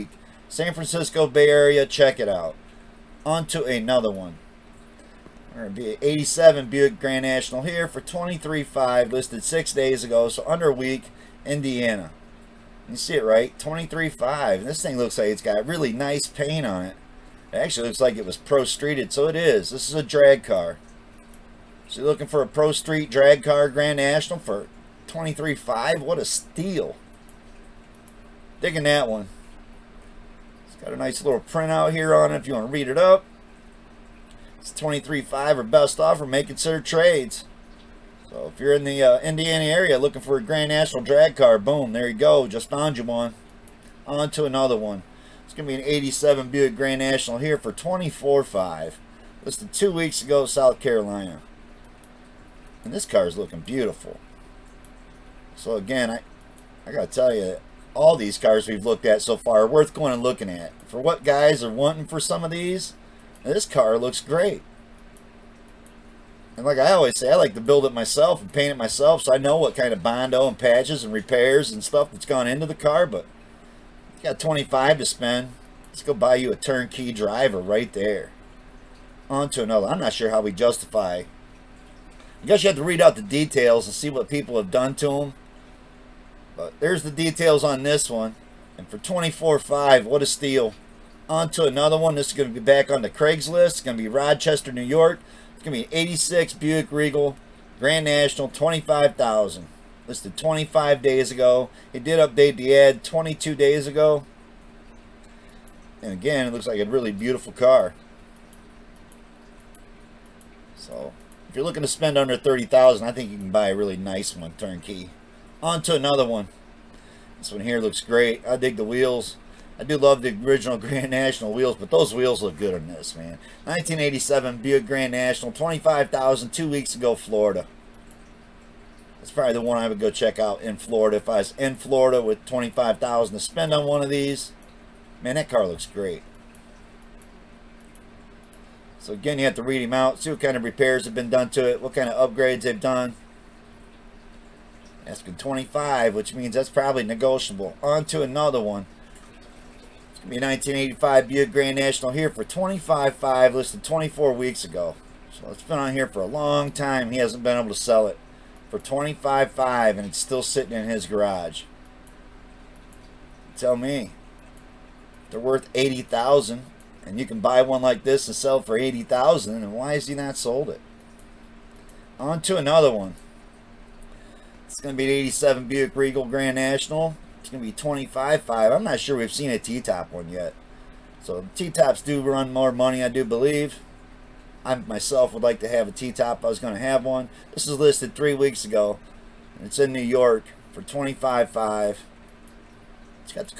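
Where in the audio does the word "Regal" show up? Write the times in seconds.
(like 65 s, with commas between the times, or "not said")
96 s, 175 s.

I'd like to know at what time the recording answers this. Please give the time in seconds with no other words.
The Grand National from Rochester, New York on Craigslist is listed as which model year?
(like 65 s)
95 s.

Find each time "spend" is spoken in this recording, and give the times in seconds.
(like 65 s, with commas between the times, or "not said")
75 s, 111 s, 133 s.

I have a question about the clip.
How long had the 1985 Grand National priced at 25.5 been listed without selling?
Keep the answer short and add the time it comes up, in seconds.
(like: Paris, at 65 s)
24 weeks, at 153 s.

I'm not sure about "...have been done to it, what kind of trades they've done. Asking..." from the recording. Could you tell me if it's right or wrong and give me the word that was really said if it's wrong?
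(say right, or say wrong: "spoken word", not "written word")
wrong: "upgrades", not "trades".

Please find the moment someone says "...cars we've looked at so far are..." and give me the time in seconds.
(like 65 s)
58 s.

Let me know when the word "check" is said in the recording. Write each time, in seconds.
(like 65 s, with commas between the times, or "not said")
1 s, 130 s.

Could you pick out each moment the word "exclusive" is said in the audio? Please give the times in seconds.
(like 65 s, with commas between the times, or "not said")
not said.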